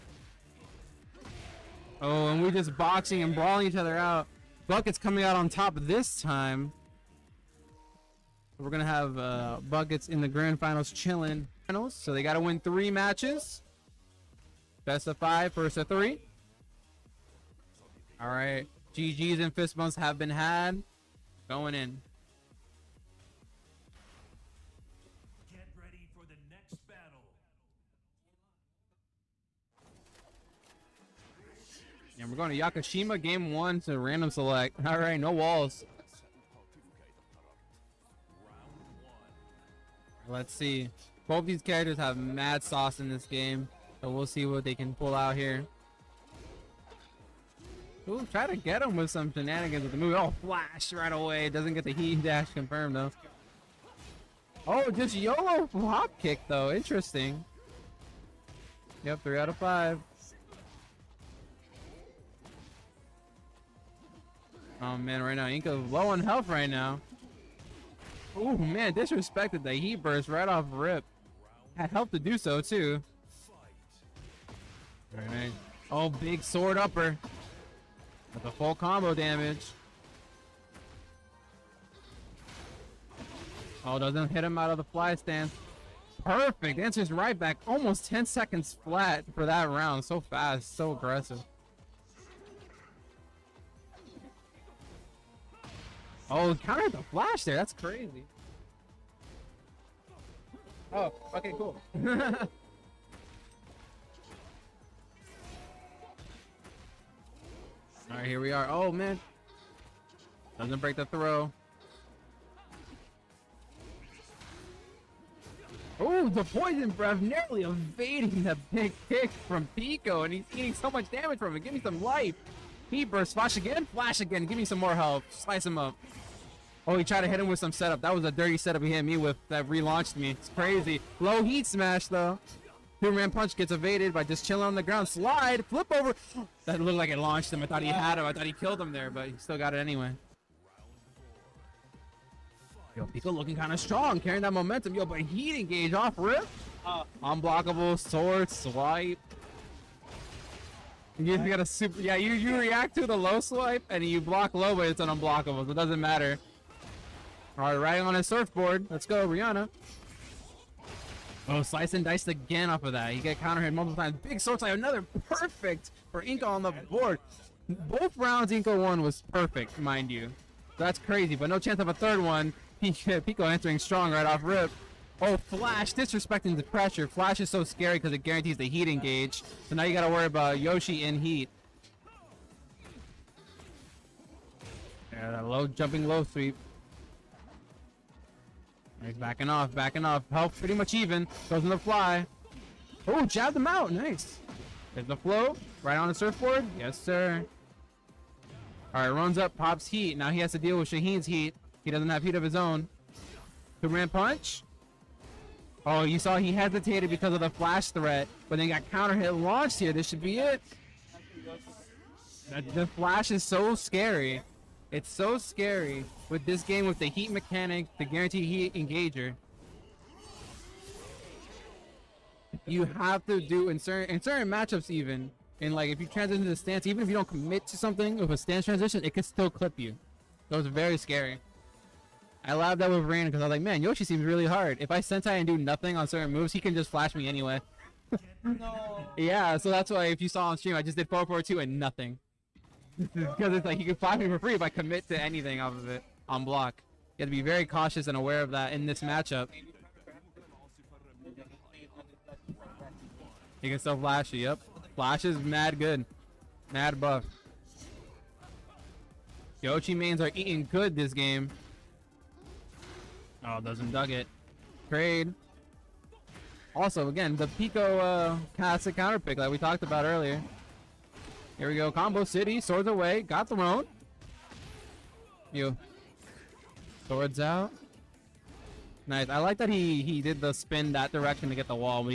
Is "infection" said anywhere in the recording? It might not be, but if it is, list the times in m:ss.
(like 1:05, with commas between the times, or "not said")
not said.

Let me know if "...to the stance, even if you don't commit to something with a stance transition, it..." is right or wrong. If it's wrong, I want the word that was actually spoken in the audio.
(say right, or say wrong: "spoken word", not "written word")
right.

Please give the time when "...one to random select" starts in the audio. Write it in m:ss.
0:33.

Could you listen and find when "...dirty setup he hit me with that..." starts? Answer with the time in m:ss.
2:08.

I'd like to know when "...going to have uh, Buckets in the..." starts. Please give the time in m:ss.
0:08.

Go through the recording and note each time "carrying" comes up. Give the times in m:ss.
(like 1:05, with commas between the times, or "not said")
2:24.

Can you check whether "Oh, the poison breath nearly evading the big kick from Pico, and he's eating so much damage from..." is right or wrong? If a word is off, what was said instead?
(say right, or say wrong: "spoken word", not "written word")
right.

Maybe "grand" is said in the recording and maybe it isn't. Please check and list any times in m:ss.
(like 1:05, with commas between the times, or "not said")
0:10.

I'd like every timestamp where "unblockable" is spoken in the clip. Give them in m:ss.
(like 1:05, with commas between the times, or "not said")
2:27, 2:35.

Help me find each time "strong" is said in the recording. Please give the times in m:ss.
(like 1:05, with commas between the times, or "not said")
2:23, 2:53.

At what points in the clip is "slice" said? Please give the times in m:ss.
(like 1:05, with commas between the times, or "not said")
2:05, 2:41.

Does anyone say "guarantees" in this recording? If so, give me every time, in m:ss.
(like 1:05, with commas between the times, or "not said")
2:58, 3:38.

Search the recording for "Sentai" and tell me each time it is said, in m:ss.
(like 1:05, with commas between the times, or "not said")
3:55.